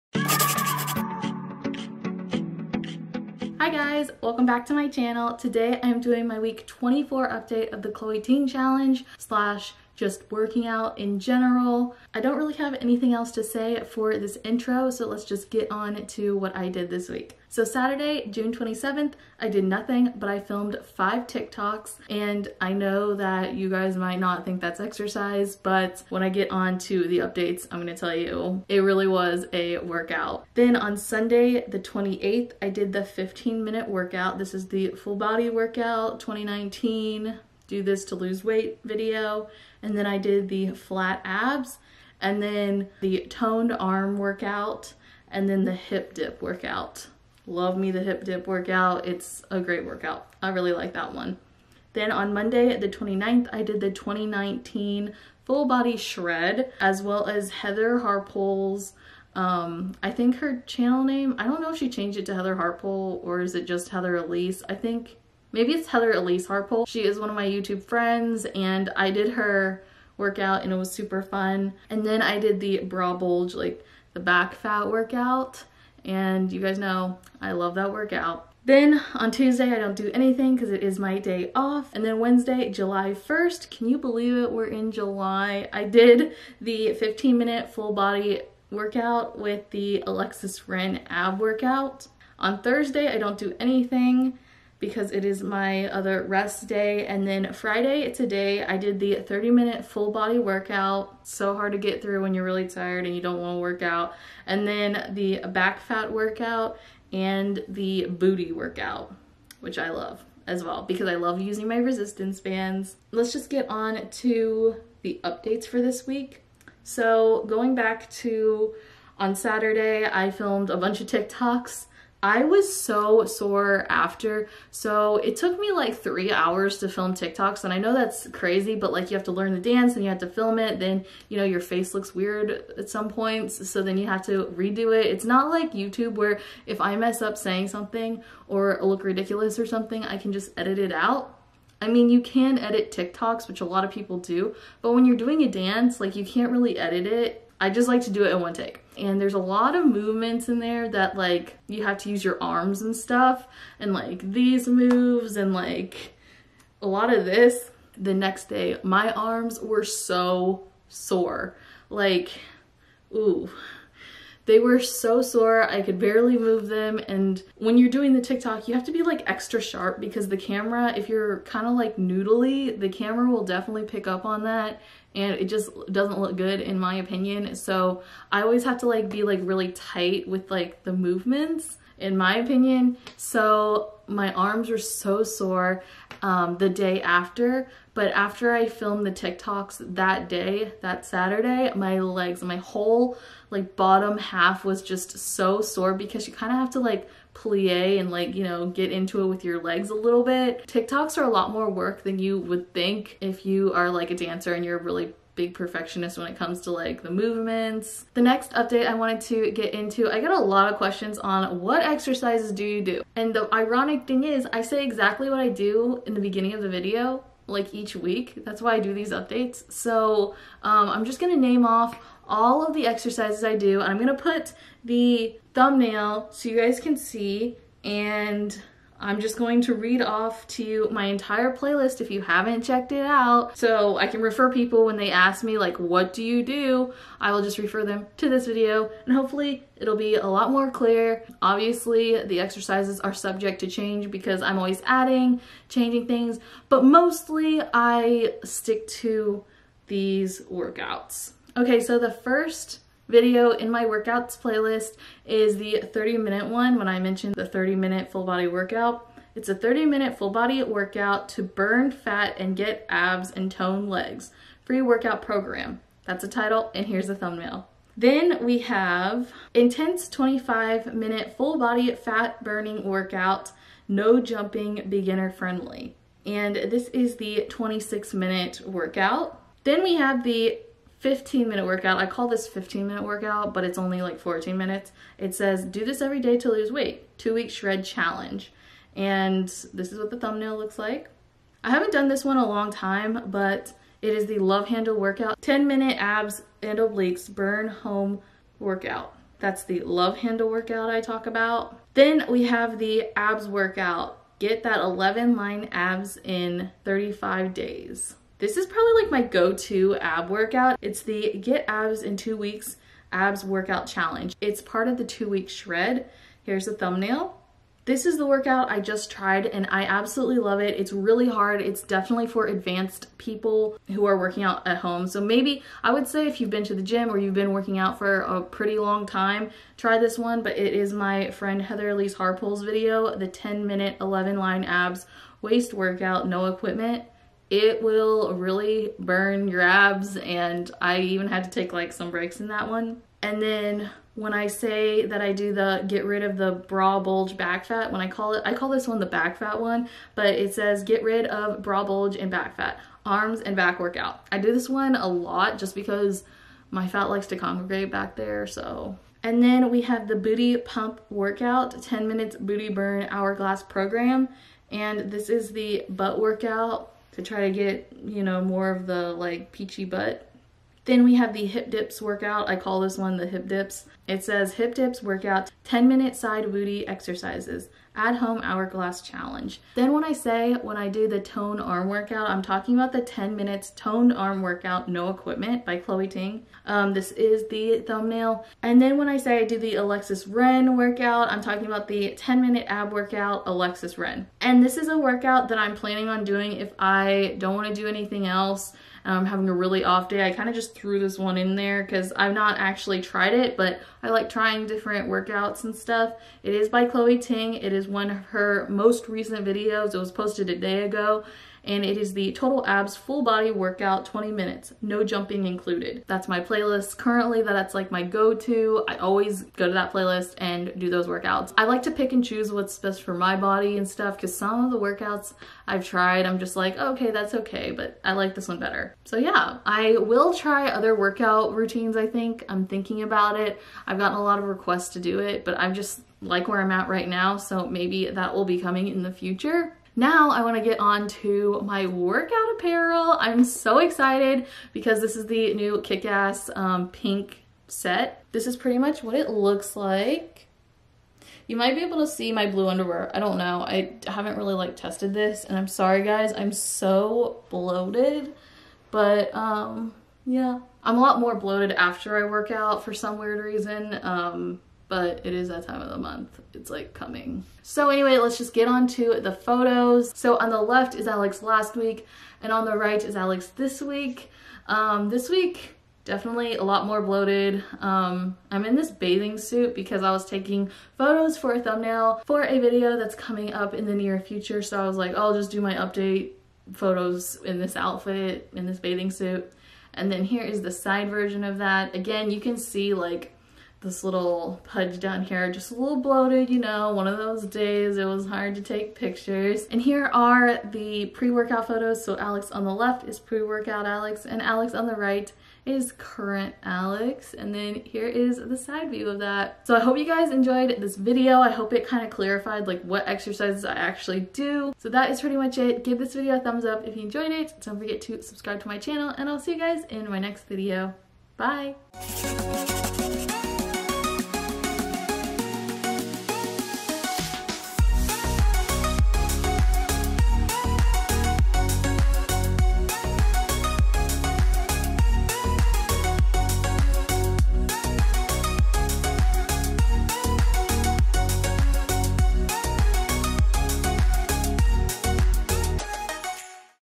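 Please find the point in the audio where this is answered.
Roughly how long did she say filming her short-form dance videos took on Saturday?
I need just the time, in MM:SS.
02:05.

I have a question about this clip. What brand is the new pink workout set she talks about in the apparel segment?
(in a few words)
Kick-Ass.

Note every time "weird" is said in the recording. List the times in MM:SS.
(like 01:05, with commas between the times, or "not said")
02:12, 07:43.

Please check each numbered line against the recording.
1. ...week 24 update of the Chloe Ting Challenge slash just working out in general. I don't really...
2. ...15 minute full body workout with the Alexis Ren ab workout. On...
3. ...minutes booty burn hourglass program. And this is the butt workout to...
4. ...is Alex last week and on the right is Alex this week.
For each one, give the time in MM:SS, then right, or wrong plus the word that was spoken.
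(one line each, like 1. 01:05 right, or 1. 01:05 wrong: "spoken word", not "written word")
1. 00:06 right
2. 01:26 right
3. 06:02 right
4. 07:50 right.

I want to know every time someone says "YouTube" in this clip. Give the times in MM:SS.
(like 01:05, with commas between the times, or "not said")
01:07, 02:15.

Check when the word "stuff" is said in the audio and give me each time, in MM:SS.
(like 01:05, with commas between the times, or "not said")
02:32, 06:45, 07:03.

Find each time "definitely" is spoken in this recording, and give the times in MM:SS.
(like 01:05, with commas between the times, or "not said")
02:53, 05:21, 07:56.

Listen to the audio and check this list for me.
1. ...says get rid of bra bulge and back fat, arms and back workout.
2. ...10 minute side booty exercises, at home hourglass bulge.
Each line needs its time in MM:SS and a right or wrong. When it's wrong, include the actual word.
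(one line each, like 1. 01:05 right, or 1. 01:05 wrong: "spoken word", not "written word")
1. 05:50 right
2. 06:15 wrong: "challenge", not "bulge".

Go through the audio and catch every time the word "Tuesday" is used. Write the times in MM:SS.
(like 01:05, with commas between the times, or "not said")
01:19.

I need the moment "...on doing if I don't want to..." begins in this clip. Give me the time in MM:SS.
06:36.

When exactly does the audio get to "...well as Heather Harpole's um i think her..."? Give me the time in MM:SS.
00:57.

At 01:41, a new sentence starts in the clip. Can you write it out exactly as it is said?
So hard to get through when you're really tired and you don't wanna work out.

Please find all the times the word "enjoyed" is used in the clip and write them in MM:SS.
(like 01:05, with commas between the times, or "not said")
08:30, 08:37.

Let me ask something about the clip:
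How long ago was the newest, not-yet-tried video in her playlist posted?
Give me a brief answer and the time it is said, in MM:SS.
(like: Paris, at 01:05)
a day ago, at 06:50.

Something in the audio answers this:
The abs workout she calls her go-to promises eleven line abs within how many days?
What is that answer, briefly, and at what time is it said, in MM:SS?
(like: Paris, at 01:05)
35 days, at 05:06.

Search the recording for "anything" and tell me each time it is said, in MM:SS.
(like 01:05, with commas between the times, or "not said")
00:12, 01:20, 01:33, 06:37.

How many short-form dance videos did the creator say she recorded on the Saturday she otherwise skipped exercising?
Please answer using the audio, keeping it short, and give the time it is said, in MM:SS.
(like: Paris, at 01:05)
5, at 00:20.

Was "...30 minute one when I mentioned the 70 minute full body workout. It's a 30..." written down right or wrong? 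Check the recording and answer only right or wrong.
wrong.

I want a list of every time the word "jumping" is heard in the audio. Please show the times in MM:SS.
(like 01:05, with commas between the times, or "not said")
04:34, 06:55.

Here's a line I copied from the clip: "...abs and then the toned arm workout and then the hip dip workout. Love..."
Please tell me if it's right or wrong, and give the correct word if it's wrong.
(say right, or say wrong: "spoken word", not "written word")
right.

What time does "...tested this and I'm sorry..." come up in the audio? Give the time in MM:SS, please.
07:34.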